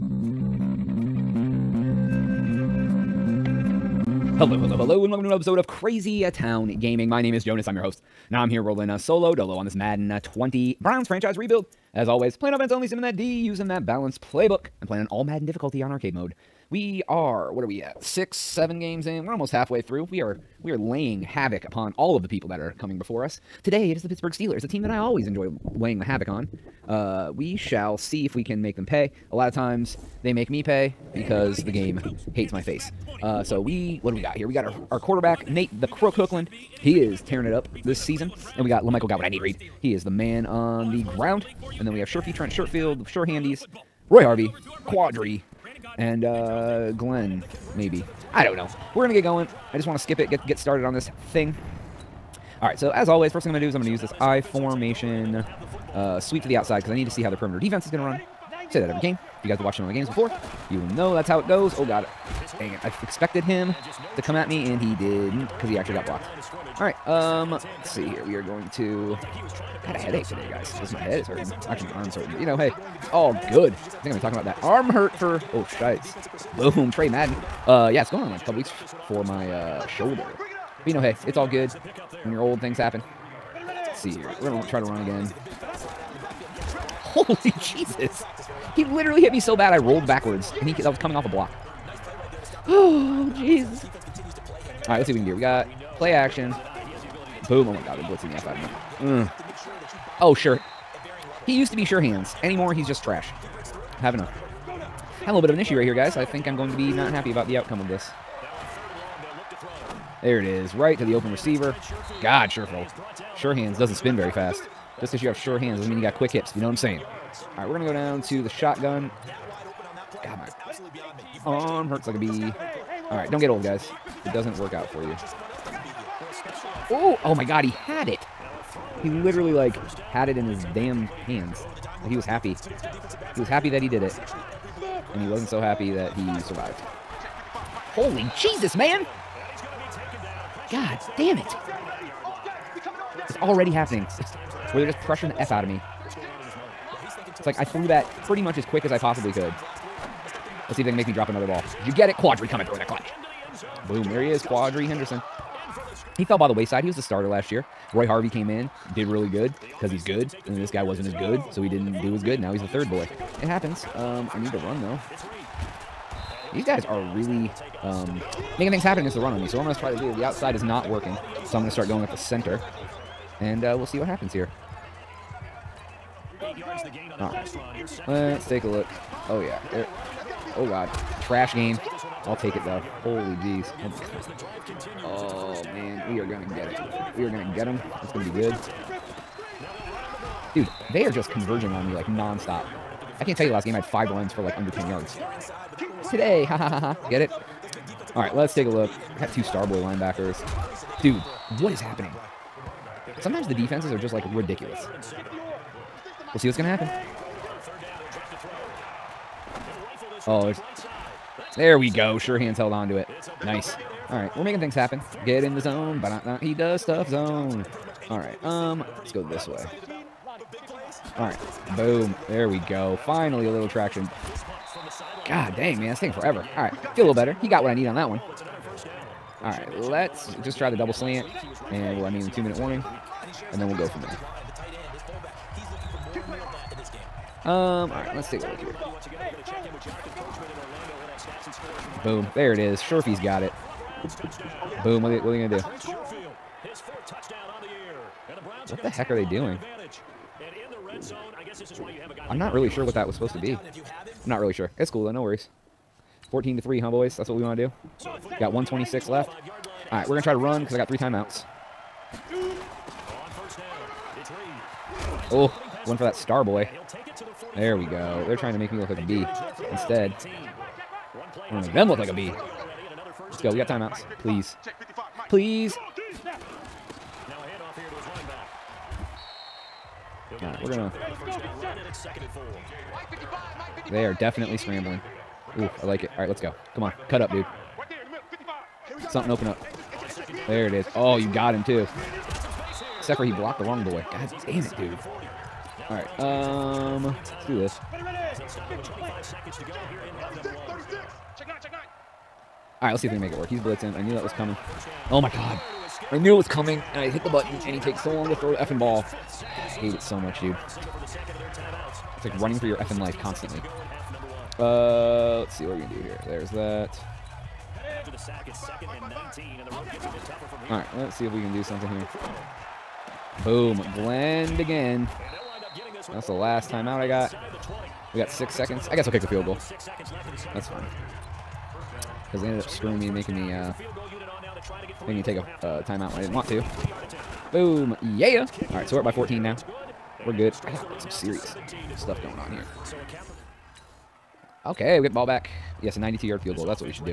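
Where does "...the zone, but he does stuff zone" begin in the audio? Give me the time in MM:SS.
03:35.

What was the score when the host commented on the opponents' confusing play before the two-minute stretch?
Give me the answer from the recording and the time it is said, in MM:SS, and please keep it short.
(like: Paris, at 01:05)
14 to 3, at 04:16.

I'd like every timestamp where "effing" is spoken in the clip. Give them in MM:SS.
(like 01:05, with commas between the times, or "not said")
05:08, 05:12.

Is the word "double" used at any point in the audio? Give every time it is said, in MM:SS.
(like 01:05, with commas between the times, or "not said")
03:50.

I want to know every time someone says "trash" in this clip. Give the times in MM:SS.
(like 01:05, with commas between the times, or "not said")
01:43, 03:01.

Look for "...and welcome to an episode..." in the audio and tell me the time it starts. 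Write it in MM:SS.
00:05.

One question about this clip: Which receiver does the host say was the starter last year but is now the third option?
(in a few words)
Quadree Henderson.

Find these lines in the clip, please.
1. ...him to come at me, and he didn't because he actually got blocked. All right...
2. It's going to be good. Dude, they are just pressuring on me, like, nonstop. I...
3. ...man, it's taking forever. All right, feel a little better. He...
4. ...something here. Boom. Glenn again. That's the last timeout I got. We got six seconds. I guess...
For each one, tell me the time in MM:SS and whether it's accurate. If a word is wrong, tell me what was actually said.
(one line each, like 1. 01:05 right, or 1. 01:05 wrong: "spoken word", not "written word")
1. 01:03 right
2. 03:08 wrong: "converging", not "pressuring"
3. 03:45 right
4. 05:21 right.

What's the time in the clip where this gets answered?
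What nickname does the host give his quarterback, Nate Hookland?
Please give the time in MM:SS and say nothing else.
00:35.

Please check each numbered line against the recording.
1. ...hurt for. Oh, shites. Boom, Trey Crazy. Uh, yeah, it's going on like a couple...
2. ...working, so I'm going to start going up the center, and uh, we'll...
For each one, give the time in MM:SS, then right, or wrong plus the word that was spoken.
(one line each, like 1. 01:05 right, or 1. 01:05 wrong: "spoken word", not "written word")
1. 01:14 wrong: "Madden", not "Crazy"
2. 02:50 right.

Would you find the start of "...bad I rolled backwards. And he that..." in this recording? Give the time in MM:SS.
01:29.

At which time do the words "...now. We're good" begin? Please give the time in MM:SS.
05:39.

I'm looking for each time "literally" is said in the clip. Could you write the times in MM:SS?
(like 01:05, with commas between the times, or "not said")
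01:28, 02:09.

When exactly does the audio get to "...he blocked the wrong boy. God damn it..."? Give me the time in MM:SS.
04:53.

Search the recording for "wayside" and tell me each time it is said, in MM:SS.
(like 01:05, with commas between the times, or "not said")
02:36.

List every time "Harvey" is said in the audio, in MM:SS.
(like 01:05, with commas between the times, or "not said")
00:44, 02:38.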